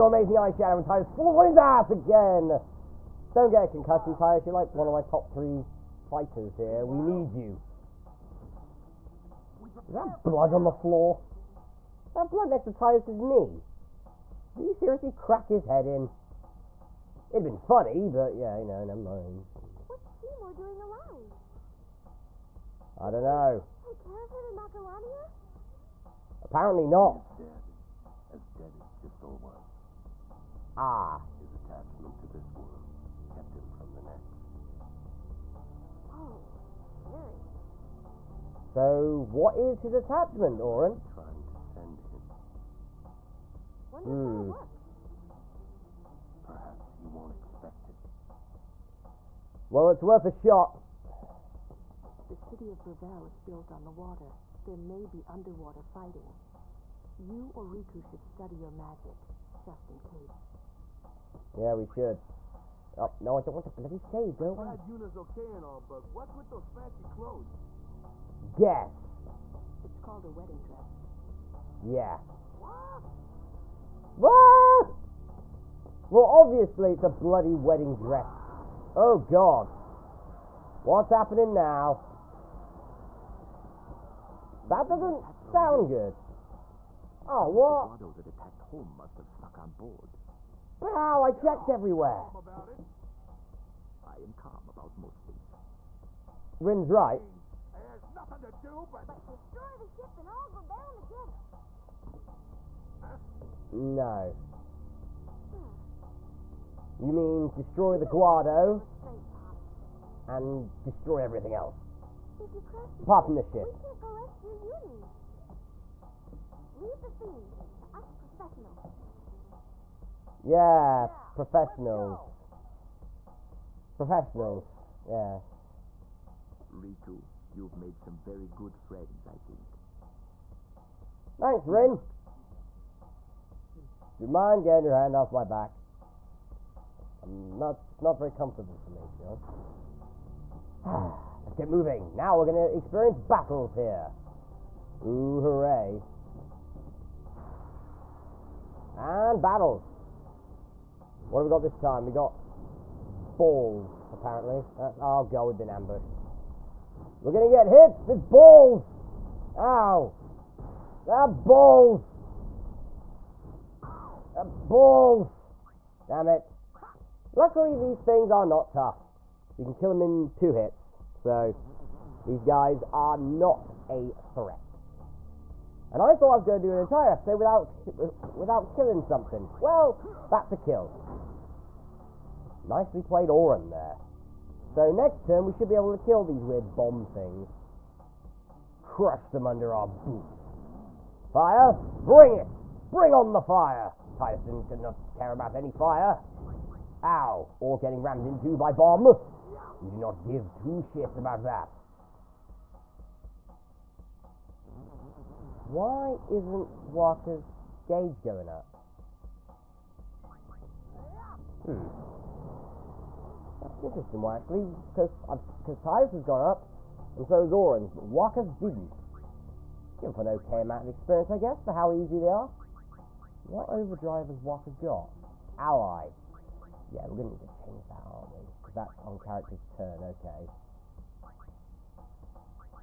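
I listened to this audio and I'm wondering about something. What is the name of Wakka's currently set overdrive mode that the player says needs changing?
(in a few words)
Ally.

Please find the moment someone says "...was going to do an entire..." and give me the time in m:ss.
2:56.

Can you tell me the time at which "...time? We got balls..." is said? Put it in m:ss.
2:31.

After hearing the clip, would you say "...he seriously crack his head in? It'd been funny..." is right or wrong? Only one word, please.
right.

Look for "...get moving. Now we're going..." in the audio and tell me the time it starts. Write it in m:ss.
2:21.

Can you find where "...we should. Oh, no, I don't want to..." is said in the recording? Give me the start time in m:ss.
1:01.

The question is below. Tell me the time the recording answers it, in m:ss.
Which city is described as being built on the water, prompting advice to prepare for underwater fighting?
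0:52.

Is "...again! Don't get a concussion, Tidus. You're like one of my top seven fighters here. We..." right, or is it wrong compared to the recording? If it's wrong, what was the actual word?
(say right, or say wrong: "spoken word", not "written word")
wrong: "three", not "seven".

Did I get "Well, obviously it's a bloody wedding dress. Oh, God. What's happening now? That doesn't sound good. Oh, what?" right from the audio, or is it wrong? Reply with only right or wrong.
right.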